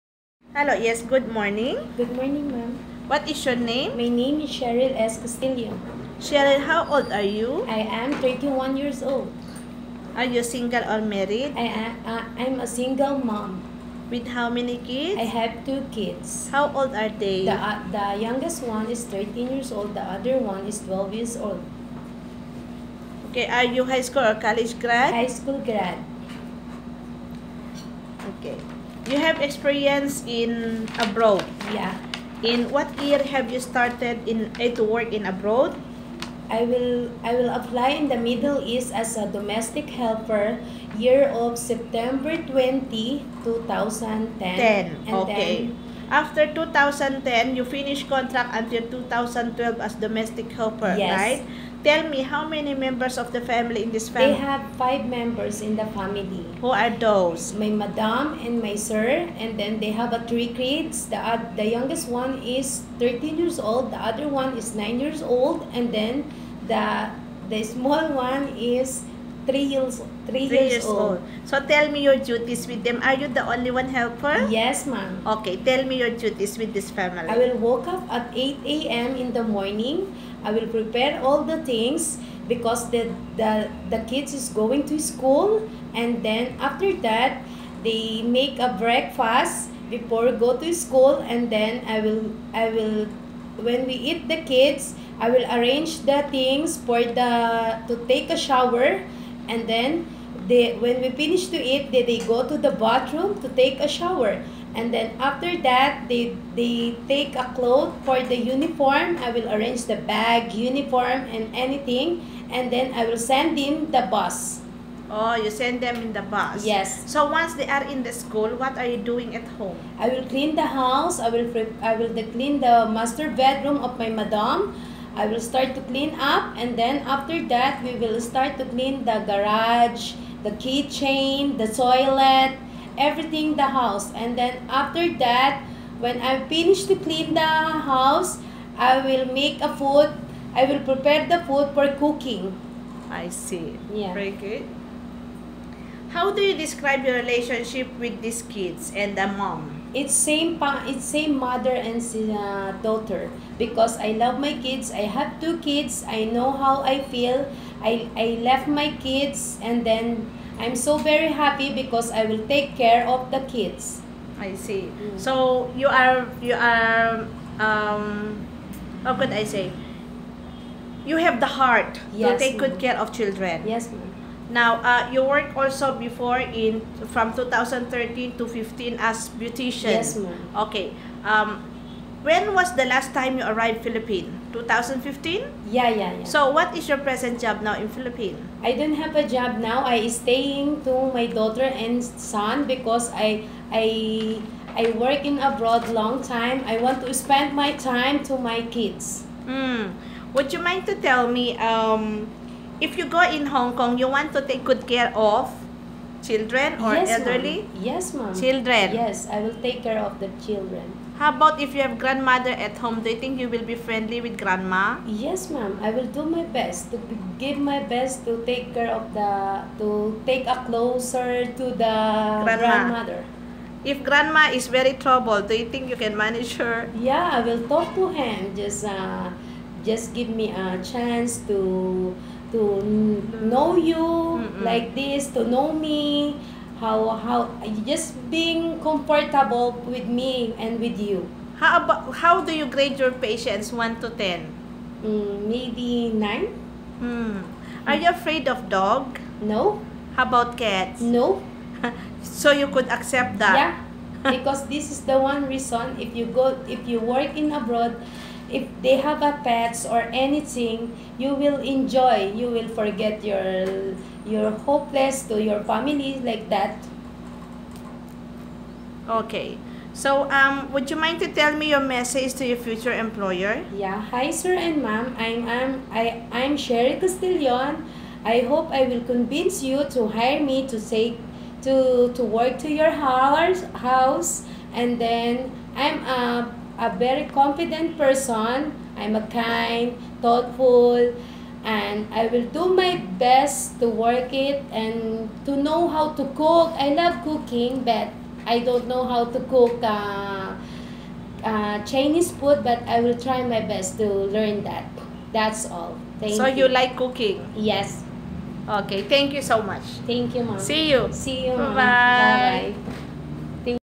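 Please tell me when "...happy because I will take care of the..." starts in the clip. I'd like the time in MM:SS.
02:41.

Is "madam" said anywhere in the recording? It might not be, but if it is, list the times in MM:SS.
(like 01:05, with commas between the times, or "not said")
00:57, 02:04.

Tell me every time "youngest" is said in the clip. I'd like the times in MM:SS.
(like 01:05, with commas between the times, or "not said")
00:18, 01:01.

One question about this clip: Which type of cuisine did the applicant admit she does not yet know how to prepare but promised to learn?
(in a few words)
Chinese food.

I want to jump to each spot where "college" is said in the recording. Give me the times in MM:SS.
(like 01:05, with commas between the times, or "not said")
00:24.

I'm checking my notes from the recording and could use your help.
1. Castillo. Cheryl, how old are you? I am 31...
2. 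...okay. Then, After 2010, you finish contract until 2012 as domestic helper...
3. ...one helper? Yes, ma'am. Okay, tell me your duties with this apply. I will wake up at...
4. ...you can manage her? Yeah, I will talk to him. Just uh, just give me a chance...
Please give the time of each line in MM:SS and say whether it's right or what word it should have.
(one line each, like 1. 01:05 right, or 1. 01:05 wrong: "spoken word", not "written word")
1. 00:05 right
2. 00:45 right
3. 01:13 wrong: "family", not "apply"
4. 03:45 right.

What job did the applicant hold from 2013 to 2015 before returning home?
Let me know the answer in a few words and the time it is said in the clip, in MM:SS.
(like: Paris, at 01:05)
Beautician, at 02:59.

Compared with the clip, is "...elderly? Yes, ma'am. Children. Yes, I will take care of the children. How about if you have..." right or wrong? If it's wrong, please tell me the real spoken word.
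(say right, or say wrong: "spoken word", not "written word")
right.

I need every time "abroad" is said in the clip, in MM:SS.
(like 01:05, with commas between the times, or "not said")
00:30, 00:35, 03:15, 04:17.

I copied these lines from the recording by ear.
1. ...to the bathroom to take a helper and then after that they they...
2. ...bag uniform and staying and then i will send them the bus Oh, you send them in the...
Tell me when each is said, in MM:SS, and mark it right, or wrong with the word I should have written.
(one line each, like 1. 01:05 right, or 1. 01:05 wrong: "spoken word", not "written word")
1. 01:42 wrong: "shower", not "helper"
2. 01:50 wrong: "anything", not "staying".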